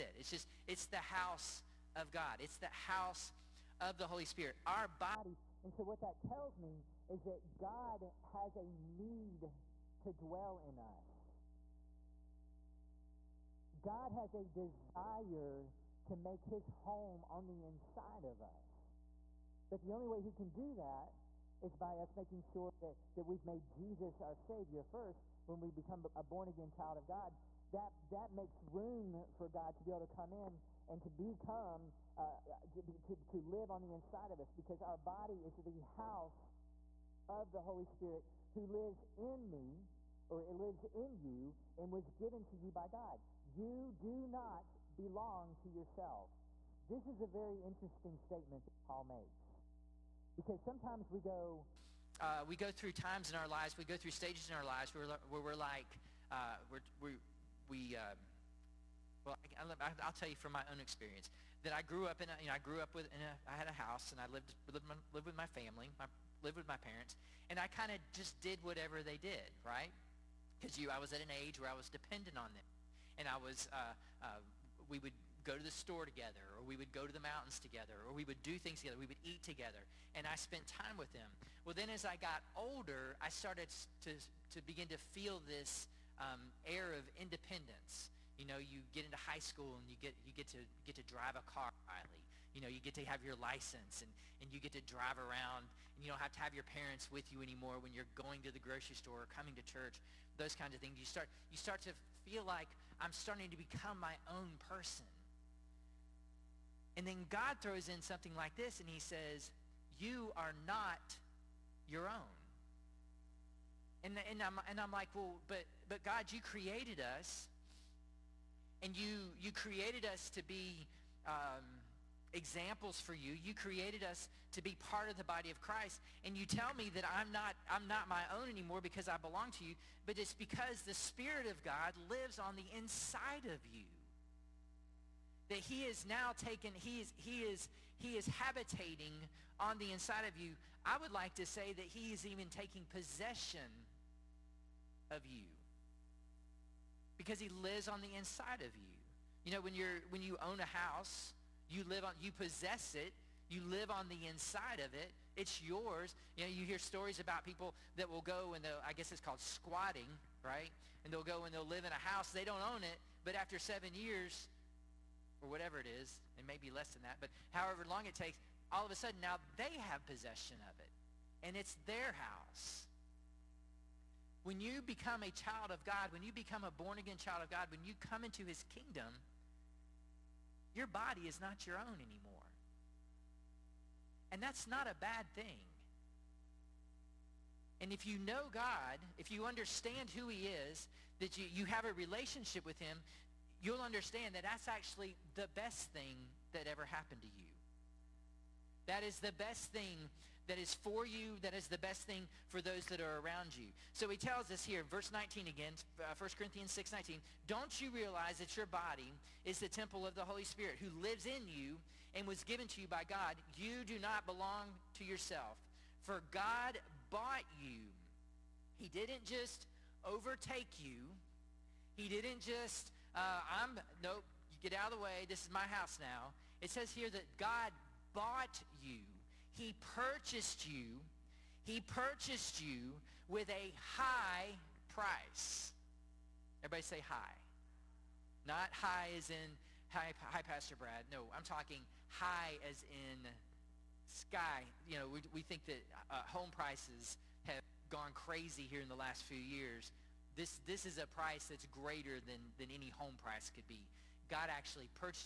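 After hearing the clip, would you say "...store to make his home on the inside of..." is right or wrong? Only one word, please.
wrong.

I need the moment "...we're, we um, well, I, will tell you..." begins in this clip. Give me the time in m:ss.
0:57.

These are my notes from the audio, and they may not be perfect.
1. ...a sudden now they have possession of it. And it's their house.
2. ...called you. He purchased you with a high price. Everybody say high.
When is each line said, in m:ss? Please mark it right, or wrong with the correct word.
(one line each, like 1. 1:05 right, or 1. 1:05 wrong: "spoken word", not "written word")
1. 2:48 right
2. 3:49 wrong: "purchased", not "called".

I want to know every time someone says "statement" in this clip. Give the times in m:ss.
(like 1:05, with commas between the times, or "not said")
0:48.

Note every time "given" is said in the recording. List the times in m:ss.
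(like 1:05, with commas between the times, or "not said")
0:42, 3:32.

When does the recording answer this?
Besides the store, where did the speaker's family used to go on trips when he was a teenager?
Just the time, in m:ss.
1:17.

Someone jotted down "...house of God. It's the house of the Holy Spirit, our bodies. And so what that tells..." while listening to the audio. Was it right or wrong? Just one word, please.
right.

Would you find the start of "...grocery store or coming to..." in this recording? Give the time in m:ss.
1:38.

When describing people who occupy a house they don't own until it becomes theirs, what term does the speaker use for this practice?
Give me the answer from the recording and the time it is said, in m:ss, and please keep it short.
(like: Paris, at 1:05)
squatting, at 2:39.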